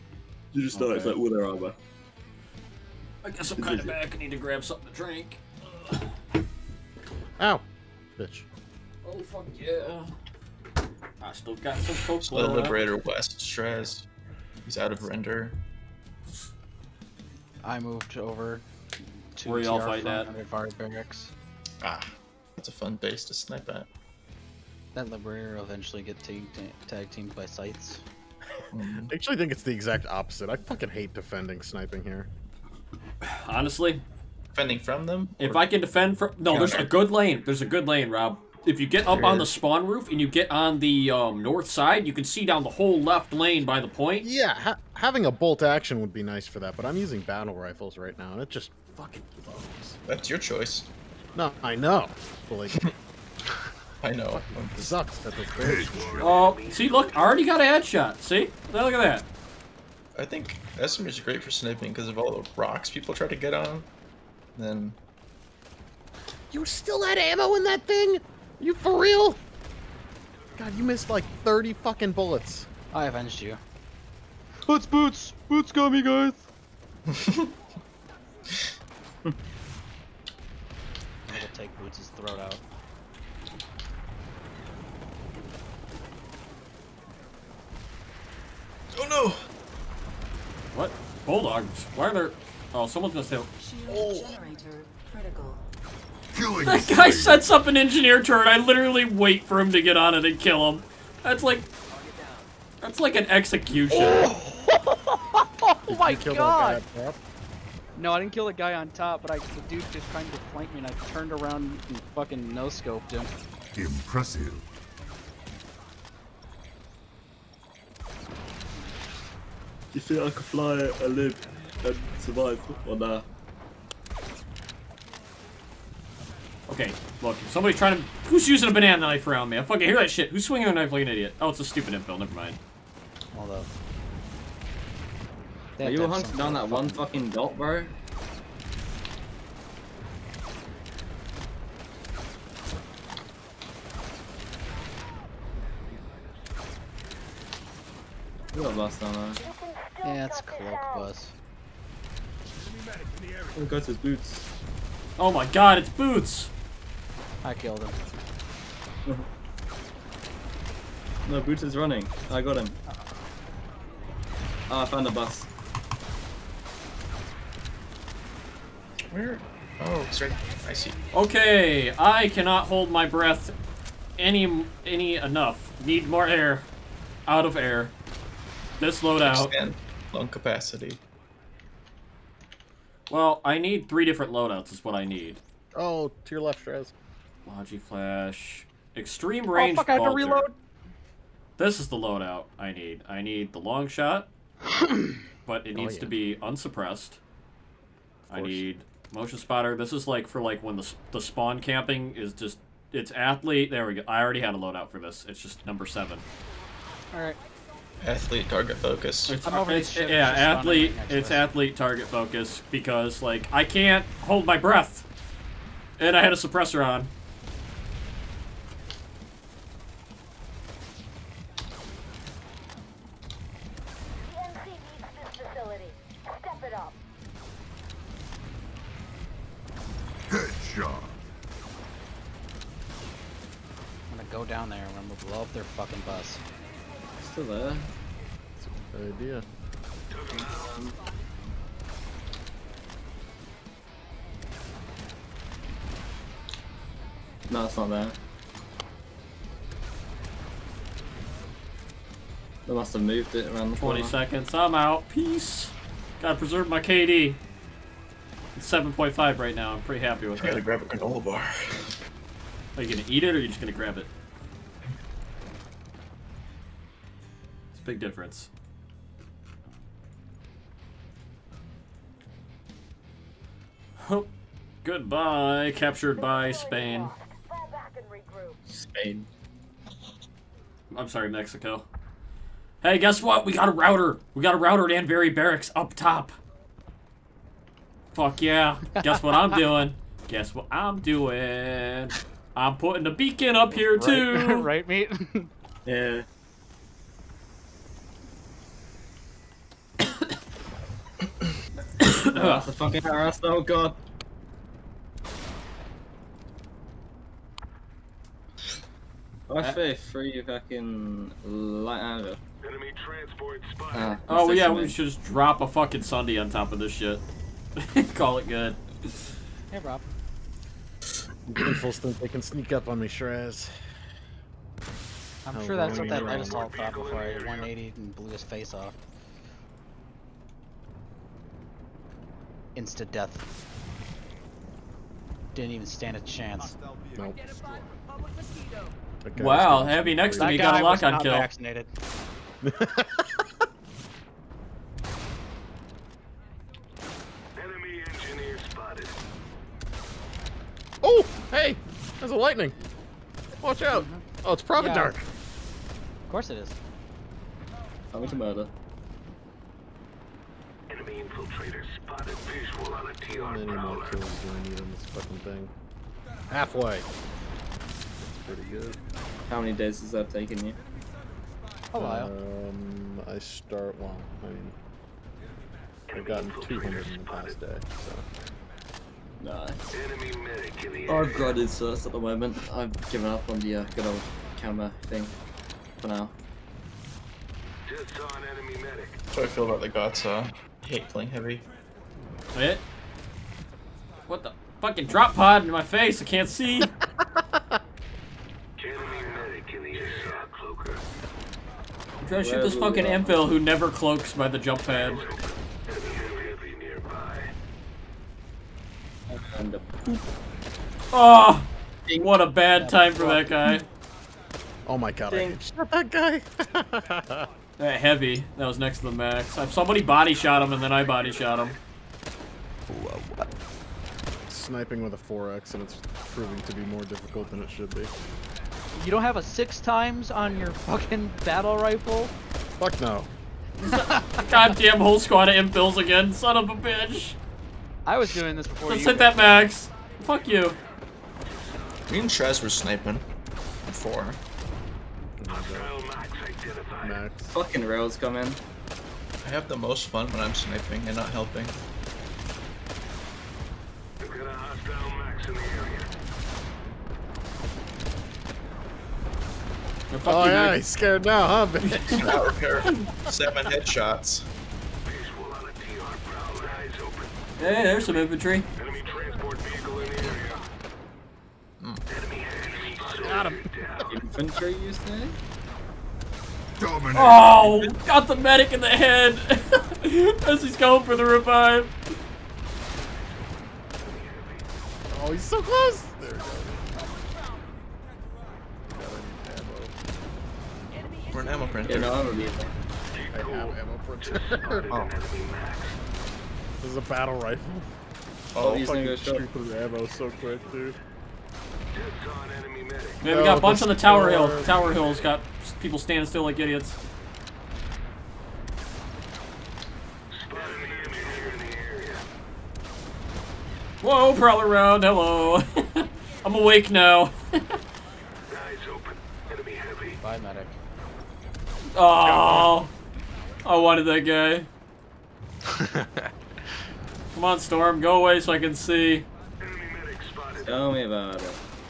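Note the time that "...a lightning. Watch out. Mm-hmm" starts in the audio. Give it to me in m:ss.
5:52.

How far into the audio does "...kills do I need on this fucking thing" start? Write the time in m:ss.
6:04.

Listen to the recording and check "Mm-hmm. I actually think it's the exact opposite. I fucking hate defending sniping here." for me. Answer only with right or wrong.
right.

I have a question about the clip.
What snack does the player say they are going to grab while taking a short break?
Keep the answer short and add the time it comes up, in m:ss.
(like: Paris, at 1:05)
granola bar, at 4:20.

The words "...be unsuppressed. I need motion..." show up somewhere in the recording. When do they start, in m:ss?
3:16.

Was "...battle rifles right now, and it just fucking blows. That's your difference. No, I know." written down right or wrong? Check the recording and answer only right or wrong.
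wrong.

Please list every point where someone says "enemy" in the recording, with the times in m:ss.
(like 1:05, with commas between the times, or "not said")
5:12, 6:00, 6:27.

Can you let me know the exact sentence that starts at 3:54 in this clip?
go down there and we're gonna blow up their fucking bus still there.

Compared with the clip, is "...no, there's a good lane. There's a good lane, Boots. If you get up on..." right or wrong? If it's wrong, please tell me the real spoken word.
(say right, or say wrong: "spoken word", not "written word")
wrong: "Rob", not "Boots".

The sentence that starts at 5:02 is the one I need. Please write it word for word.
that's a fucking harass, oh god.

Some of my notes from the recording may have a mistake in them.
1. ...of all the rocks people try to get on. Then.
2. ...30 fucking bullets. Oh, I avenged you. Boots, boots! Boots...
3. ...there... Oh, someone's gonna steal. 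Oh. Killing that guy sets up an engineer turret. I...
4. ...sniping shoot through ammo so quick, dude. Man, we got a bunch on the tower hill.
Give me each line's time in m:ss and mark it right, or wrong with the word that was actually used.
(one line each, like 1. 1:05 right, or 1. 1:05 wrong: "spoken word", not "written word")
1. 1:02 right
2. 1:11 right
3. 1:32 right
4. 8:18 wrong: "fucking", not "sniping".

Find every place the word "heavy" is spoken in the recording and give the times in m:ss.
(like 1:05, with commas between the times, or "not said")
5:39, 6:31, 6:58.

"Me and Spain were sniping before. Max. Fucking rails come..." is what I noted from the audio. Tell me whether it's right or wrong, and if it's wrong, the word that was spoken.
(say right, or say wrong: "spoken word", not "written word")
wrong: "Trez", not "Spain".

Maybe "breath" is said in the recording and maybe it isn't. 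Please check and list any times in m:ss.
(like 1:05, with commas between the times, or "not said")
2:53, 3:34.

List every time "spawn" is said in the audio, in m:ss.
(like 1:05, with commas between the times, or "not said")
0:39, 3:21.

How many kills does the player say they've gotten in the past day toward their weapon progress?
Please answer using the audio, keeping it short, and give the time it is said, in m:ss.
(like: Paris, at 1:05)
200, at 6:16.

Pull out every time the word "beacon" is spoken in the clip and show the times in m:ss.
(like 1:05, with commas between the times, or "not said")
4:53.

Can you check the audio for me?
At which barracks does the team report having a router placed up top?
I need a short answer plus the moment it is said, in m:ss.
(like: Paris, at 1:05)
Anbury Barracks, at 4:45.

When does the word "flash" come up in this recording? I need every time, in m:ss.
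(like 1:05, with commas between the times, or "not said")
3:07.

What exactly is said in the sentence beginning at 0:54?
It sucks that this Oh, see, look, I already got a headshot.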